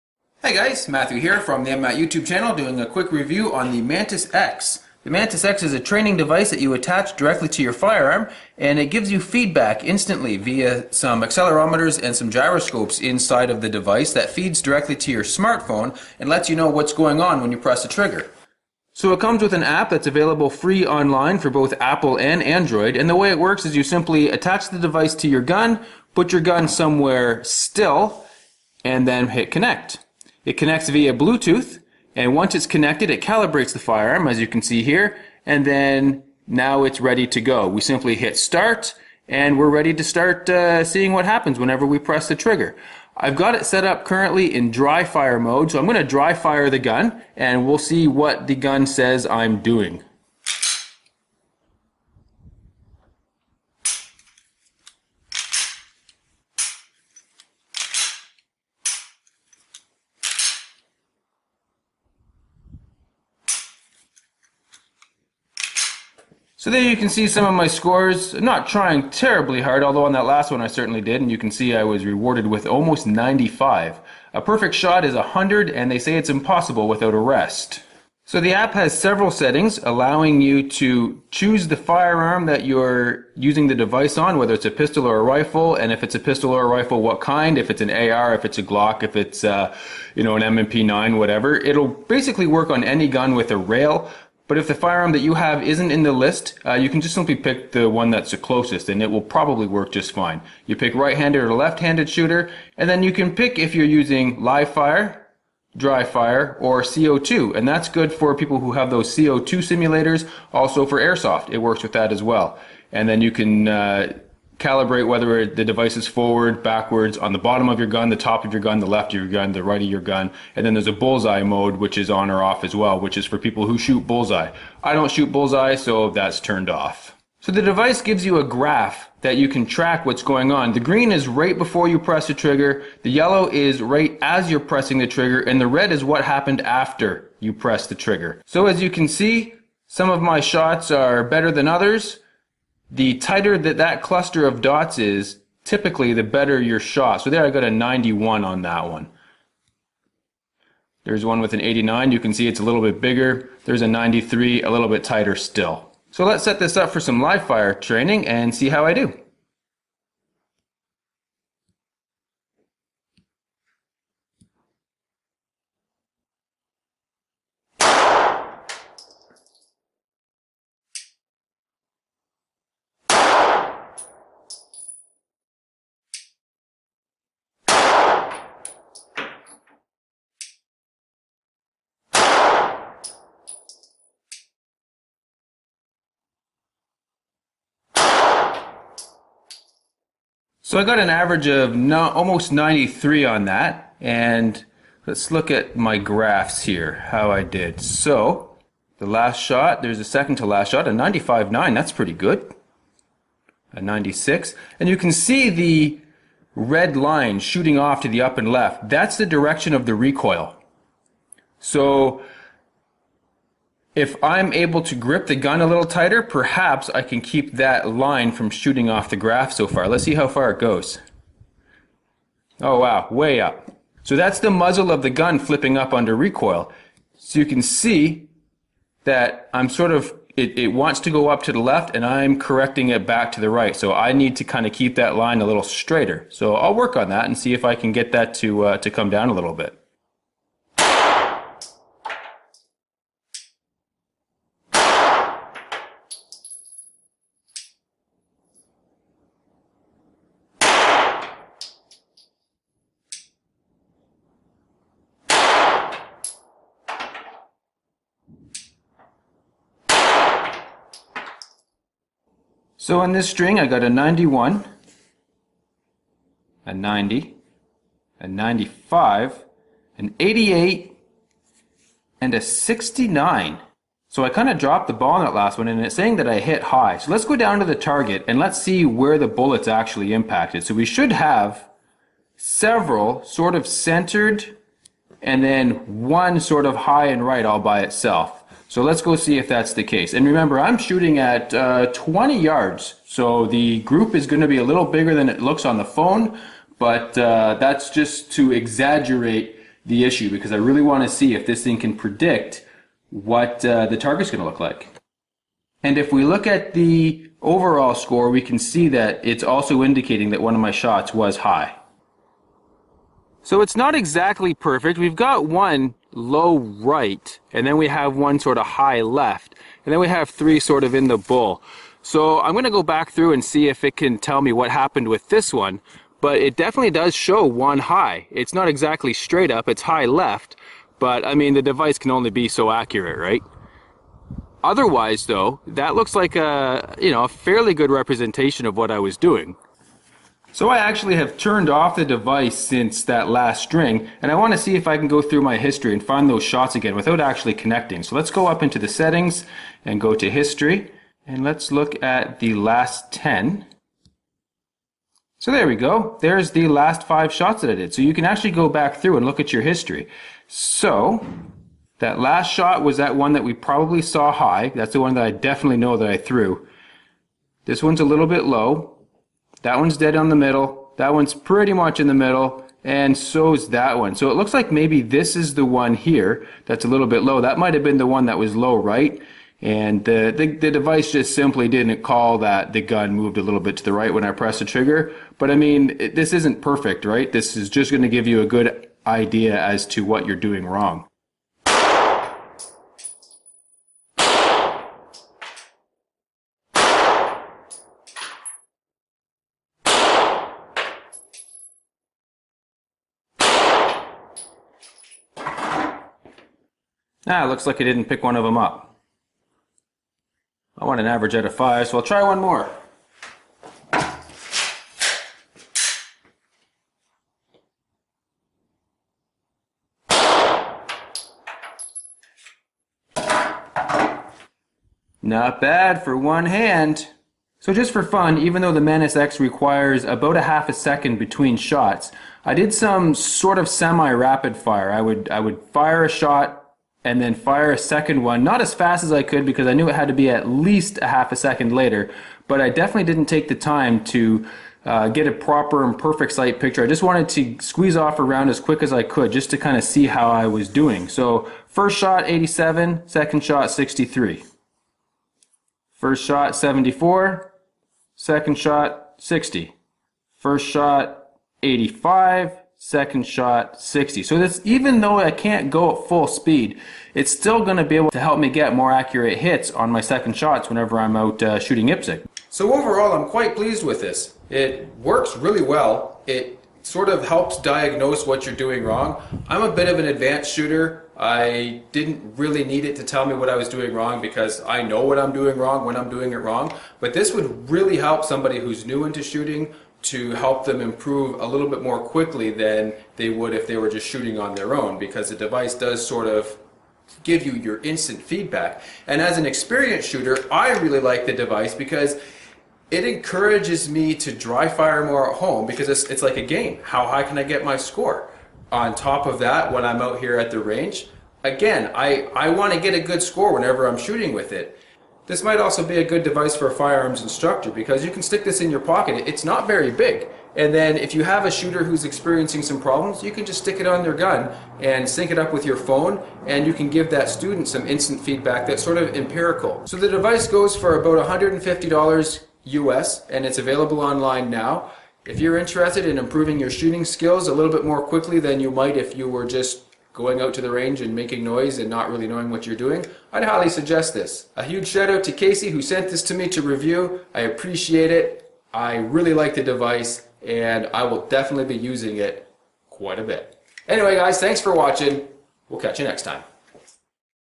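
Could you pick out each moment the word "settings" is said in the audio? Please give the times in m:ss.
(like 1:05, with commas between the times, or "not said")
1:19, 5:48.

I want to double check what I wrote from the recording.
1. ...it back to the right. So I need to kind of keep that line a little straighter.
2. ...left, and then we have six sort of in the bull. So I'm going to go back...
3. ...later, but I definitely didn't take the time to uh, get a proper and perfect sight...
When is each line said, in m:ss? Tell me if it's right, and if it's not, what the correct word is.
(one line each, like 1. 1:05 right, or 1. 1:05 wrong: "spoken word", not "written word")
1. 3:52 right
2. 5:19 wrong: "three", not "six"
3. 7:21 right.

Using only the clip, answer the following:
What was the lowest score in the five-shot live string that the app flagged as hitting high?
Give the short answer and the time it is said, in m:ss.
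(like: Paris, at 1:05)
69, at 4:32.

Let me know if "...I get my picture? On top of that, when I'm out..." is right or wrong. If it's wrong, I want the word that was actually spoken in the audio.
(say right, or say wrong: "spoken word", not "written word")
wrong: "score", not "picture".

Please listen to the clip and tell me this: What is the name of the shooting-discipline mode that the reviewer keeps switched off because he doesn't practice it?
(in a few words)
bullseye mode.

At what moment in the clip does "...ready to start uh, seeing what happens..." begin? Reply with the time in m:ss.
0:39.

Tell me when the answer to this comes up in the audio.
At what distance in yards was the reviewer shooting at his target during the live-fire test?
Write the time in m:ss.
4:51.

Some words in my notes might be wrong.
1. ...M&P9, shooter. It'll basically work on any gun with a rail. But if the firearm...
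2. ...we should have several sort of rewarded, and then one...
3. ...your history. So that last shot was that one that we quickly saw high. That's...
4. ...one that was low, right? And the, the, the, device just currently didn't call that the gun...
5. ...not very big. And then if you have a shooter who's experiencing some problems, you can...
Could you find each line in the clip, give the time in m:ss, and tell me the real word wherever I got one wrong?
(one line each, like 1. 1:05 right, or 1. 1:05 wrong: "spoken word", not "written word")
1. 1:30 wrong: "whatever", not "shooter"
2. 4:40 wrong: "centered", not "rewarded"
3. 5:59 wrong: "probably", not "quickly"
4. 6:18 wrong: "simply", not "currently"
5. 8:39 right.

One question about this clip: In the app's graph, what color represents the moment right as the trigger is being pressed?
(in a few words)
Yellow.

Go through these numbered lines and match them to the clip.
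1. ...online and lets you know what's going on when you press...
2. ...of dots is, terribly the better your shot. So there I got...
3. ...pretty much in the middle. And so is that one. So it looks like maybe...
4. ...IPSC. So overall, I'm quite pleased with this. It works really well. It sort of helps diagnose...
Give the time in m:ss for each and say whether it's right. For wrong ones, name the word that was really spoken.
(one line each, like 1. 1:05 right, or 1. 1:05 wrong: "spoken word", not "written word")
1. 0:15 wrong: "smartphone", not "online"
2. 2:24 wrong: "typically", not "terribly"
3. 6:11 right
4. 7:51 right.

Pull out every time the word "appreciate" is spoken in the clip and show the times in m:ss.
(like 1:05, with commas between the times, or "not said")
9:07.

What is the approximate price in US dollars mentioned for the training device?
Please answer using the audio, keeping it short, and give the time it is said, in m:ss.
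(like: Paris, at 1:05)
$150, at 8:51.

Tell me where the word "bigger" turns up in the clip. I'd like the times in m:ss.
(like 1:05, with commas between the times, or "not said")
2:33, 4:54.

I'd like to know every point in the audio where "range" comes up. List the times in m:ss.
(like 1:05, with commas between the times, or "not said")
8:30, 9:00.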